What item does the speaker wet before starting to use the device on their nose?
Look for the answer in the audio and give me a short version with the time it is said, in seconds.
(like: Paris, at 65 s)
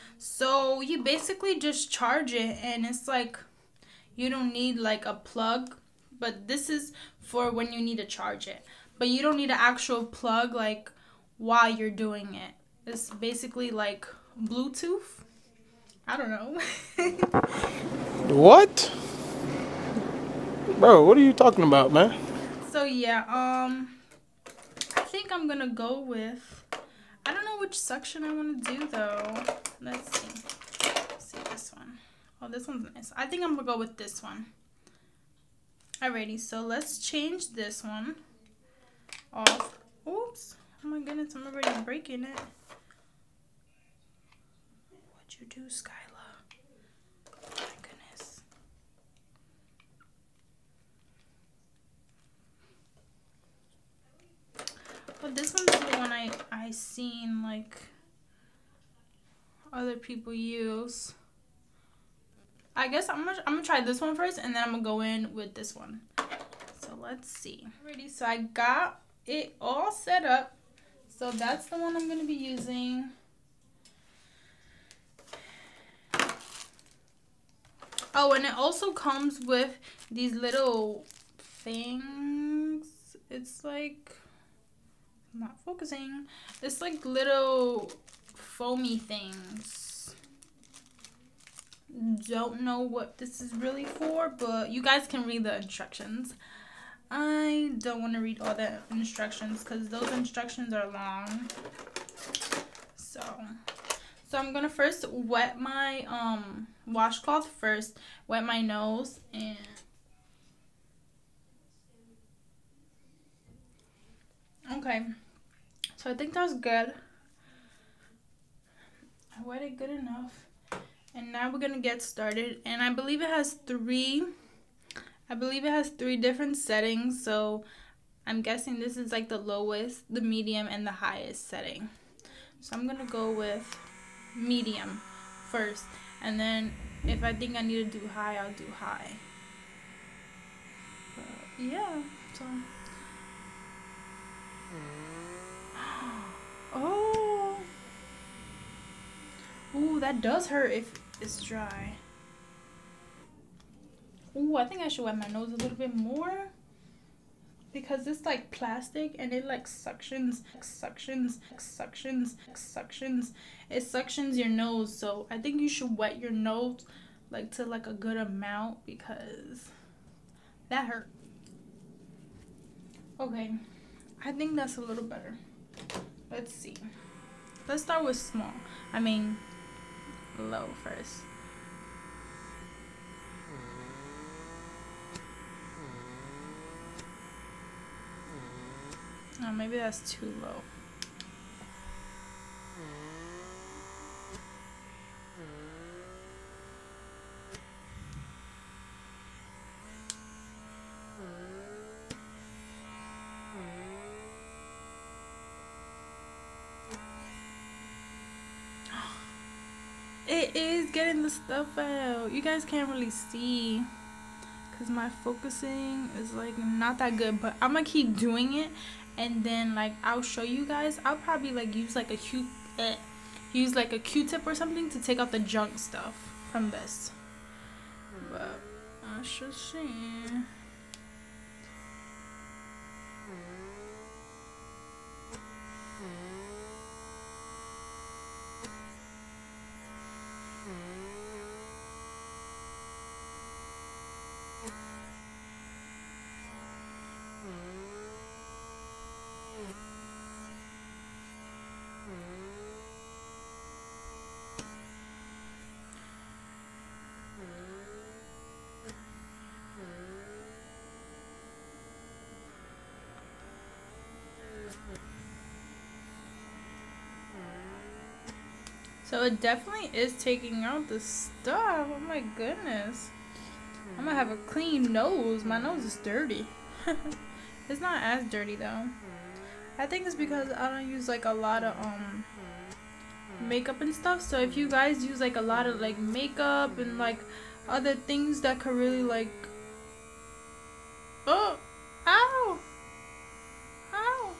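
washcloth, at 106 s.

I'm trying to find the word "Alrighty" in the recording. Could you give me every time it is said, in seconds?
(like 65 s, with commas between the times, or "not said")
36 s, 67 s.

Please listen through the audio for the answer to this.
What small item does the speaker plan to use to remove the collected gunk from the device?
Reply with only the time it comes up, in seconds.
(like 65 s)
223 s.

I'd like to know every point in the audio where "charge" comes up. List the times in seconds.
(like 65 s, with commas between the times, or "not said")
1 s, 8 s.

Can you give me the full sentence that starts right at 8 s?
But you don't need an actual plug like while you're doing it.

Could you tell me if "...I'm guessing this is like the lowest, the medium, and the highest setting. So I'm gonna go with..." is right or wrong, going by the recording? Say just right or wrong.
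right.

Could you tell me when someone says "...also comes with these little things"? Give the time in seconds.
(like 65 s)
78 s.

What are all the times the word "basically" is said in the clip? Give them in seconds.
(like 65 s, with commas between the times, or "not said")
1 s, 13 s.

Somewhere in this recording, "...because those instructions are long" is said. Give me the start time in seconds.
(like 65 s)
99 s.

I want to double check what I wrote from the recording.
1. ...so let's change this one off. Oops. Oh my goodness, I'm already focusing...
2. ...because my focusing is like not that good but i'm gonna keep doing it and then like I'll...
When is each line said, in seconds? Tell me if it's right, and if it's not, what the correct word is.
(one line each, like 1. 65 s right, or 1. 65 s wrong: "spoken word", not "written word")
1. 36 s wrong: "breaking", not "focusing"
2. 214 s right.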